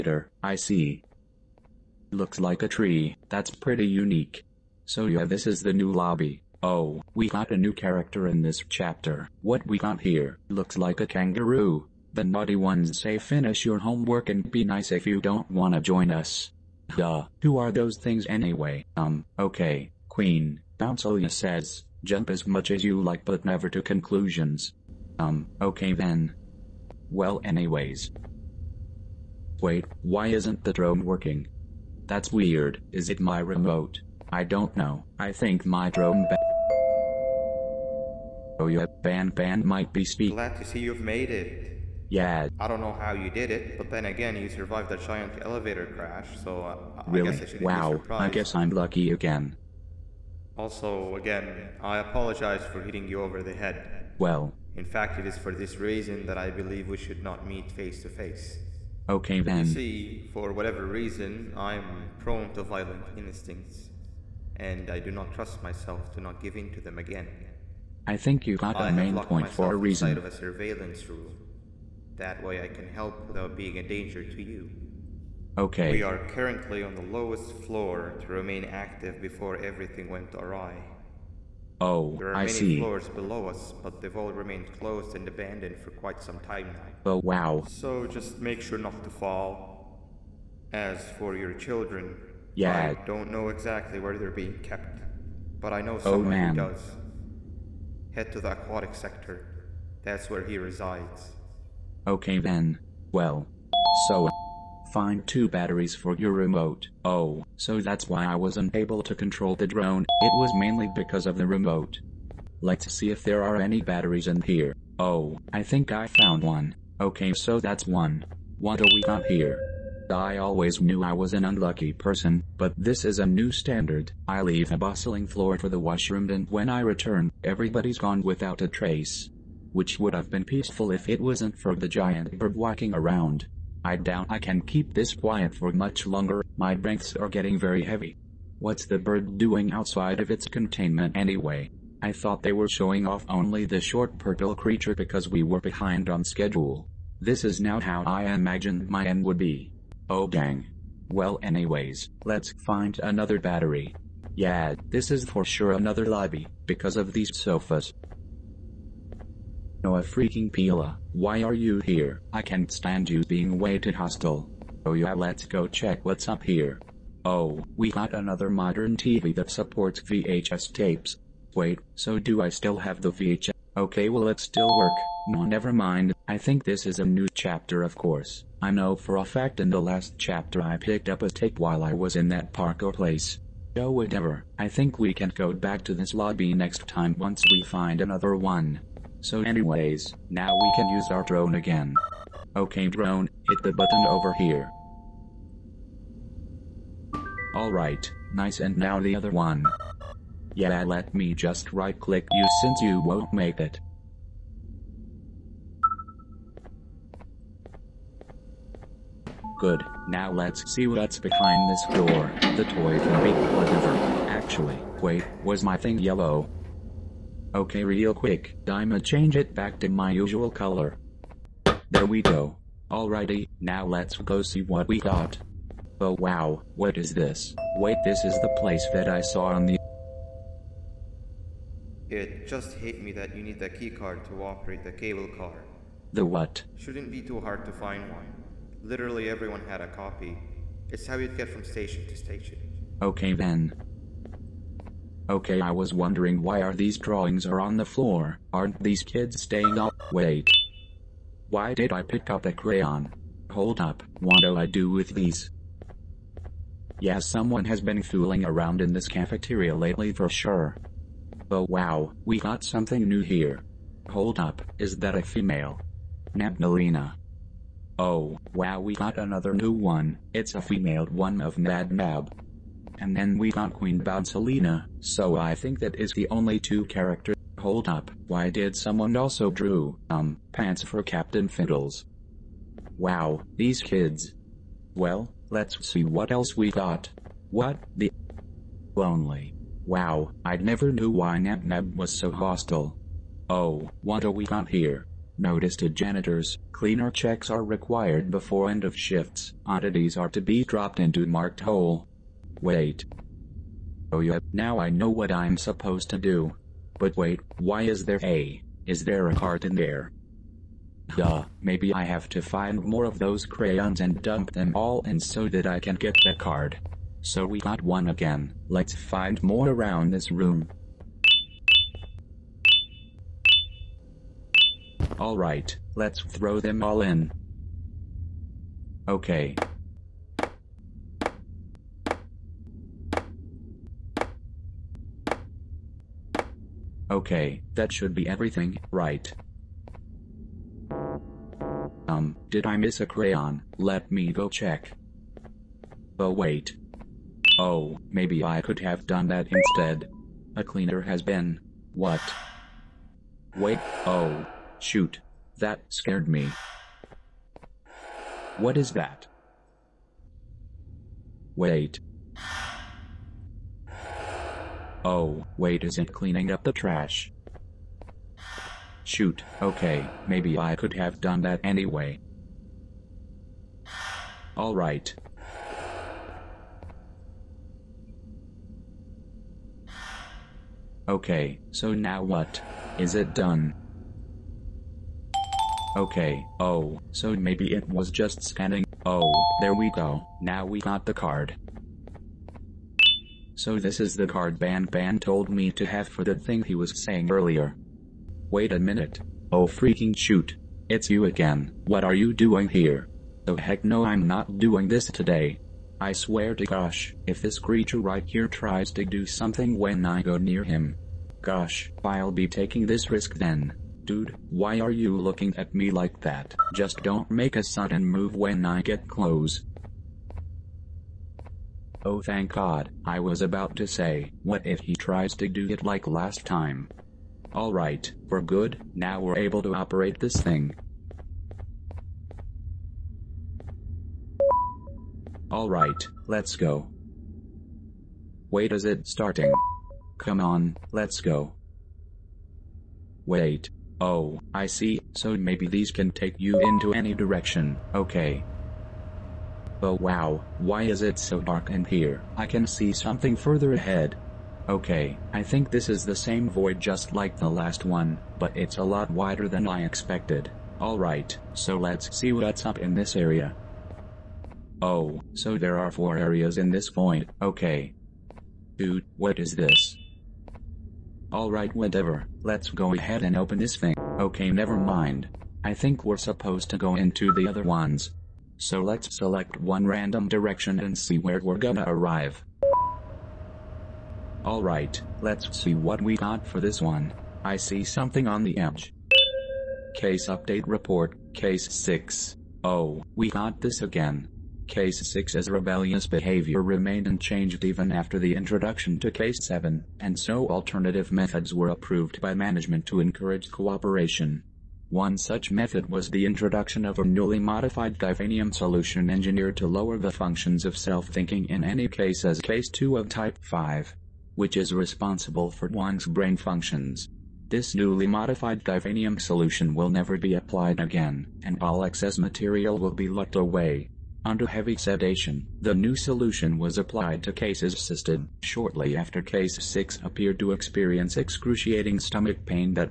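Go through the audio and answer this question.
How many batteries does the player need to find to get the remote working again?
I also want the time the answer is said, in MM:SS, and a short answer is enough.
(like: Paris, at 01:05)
2, at 01:45.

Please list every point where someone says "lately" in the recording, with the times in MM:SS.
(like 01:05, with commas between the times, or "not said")
04:19.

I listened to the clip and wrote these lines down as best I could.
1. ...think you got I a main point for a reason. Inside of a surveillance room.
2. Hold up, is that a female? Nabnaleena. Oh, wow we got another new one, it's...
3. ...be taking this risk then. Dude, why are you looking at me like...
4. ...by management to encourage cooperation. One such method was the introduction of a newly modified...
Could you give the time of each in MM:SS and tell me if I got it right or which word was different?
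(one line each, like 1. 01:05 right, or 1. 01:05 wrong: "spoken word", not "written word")
1. 01:08 right
2. 04:24 right
3. 06:52 right
4. 08:22 right.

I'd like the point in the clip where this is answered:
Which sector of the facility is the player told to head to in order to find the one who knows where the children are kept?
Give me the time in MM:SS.
01:38.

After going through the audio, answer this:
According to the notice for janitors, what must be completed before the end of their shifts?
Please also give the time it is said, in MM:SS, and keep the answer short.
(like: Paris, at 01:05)
Cleaner checks, at 04:56.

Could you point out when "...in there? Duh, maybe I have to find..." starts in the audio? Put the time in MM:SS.
05:09.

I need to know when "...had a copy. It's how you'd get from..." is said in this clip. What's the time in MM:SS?
03:59.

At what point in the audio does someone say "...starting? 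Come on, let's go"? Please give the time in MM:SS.
07:19.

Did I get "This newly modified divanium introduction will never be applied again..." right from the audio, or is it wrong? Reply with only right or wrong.
wrong.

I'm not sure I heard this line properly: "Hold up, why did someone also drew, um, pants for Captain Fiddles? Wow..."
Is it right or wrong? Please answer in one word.
right.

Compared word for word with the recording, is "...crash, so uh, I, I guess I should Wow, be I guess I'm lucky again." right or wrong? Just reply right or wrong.
right.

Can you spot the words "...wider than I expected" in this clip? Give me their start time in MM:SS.
07:39.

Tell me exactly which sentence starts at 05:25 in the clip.
Alright, let's throw them all in.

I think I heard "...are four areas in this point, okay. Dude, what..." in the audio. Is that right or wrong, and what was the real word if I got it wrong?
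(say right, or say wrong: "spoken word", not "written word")
right.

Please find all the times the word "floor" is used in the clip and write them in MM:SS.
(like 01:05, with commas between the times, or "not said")
01:17, 01:22, 02:05, 04:07.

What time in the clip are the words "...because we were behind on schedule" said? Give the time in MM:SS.
02:24.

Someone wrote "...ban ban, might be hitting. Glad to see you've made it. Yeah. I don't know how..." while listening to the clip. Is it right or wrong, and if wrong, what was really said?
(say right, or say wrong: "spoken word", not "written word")
wrong: "speaking", not "hitting".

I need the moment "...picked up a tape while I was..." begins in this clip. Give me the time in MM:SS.
03:00.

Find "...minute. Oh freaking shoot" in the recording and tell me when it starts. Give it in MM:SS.
06:38.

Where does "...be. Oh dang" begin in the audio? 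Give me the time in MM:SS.
02:29.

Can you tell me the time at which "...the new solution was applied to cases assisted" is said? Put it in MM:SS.
08:45.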